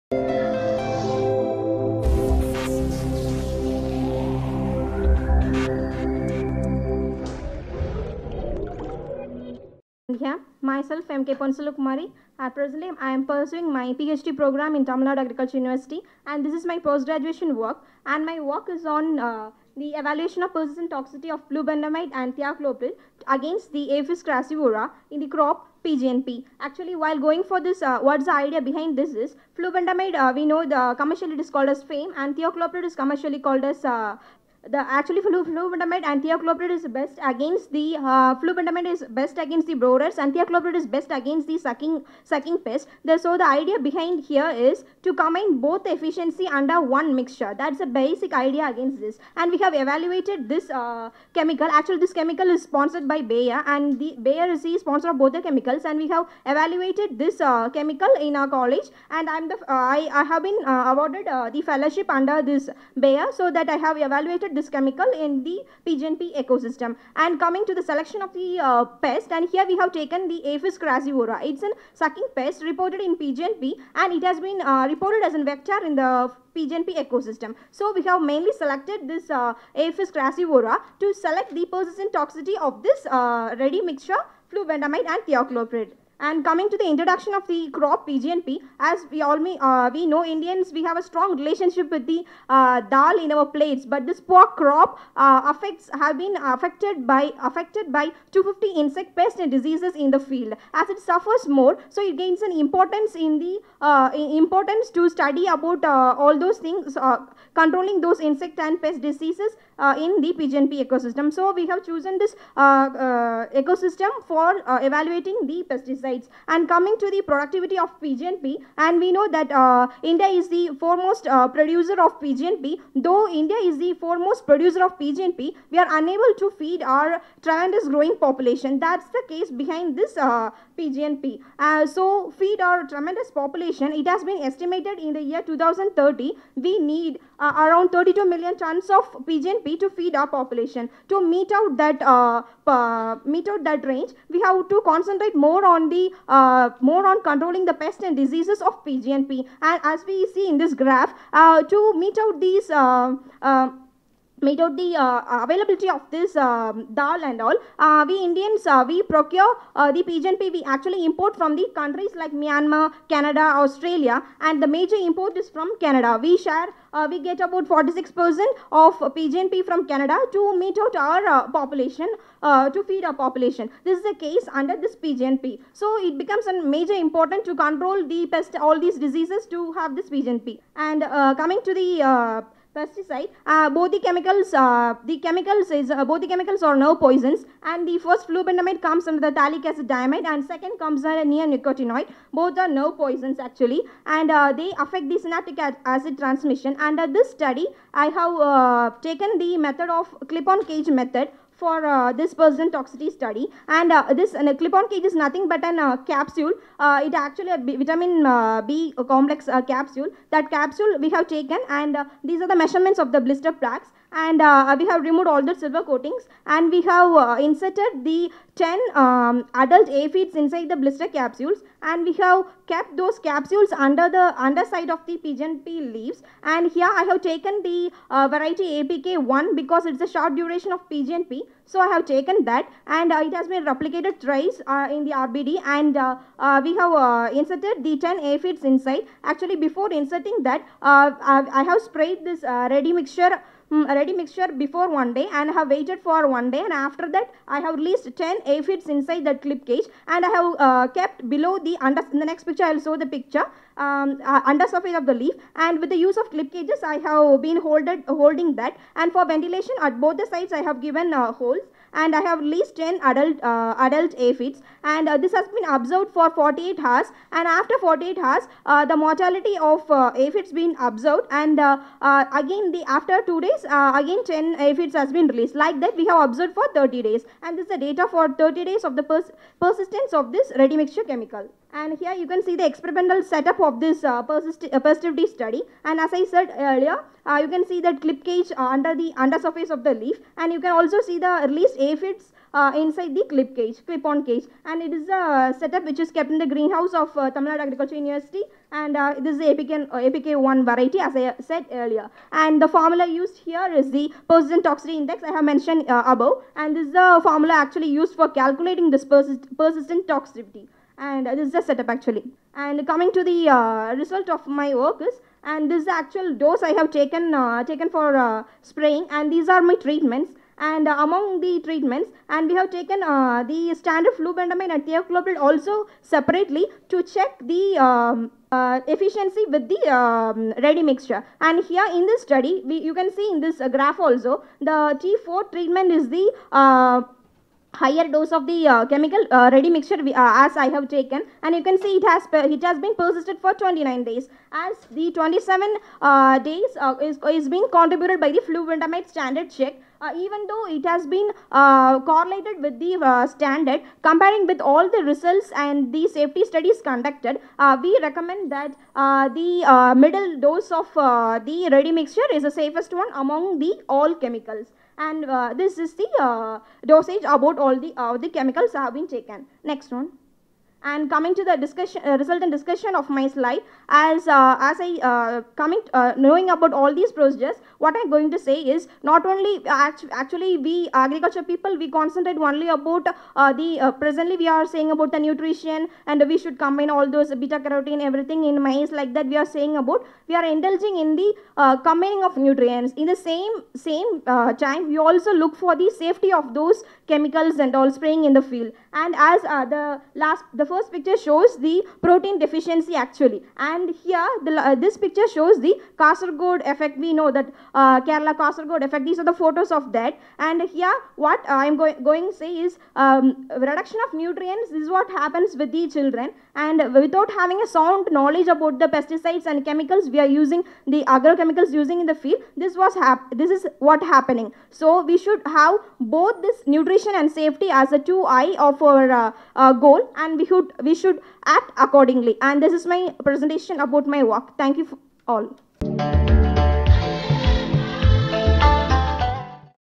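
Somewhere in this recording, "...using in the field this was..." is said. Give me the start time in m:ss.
7:01.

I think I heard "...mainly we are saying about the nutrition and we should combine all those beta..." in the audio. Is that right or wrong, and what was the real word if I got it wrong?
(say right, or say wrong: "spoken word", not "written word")
wrong: "presently", not "mainly".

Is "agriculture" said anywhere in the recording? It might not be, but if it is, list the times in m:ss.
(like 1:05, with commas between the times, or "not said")
0:15, 4:57, 6:20.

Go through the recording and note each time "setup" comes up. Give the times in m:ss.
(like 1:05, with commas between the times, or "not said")
4:43, 4:55, 5:11.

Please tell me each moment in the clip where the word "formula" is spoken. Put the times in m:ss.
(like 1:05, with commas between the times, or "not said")
5:02, 5:07.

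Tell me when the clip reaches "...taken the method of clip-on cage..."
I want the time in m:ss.
3:19.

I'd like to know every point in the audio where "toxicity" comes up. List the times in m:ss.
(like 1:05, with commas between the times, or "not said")
0:20, 1:22, 3:22, 5:04, 5:10.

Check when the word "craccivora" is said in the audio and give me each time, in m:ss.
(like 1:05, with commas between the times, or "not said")
0:24, 1:10, 1:20.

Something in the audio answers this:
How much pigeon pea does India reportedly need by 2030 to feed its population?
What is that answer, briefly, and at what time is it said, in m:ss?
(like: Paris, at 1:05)
32 million tons, at 2:17.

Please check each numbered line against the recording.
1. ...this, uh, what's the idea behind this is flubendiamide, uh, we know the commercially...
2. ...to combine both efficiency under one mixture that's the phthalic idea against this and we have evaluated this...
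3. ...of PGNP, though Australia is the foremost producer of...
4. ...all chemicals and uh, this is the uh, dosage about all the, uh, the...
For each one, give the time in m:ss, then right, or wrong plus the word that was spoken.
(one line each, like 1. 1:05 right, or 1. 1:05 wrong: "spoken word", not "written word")
1. 0:27 right
2. 0:45 wrong: "basic", not "phthalic"
3. 2:01 wrong: "India", not "Australia"
4. 6:03 right.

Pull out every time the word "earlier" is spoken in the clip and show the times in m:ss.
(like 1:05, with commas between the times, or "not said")
4:46, 5:01.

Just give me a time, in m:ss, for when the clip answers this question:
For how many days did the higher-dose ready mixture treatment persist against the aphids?
5:43.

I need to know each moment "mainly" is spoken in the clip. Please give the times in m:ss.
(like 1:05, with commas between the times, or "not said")
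1:18.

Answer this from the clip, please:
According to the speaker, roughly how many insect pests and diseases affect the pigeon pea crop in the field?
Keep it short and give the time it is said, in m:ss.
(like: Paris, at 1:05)
250, at 1:38.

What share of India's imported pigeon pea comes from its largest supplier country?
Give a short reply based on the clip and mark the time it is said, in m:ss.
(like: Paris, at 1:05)
46%, at 2:47.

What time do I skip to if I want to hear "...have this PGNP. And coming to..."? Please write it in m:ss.
2:59.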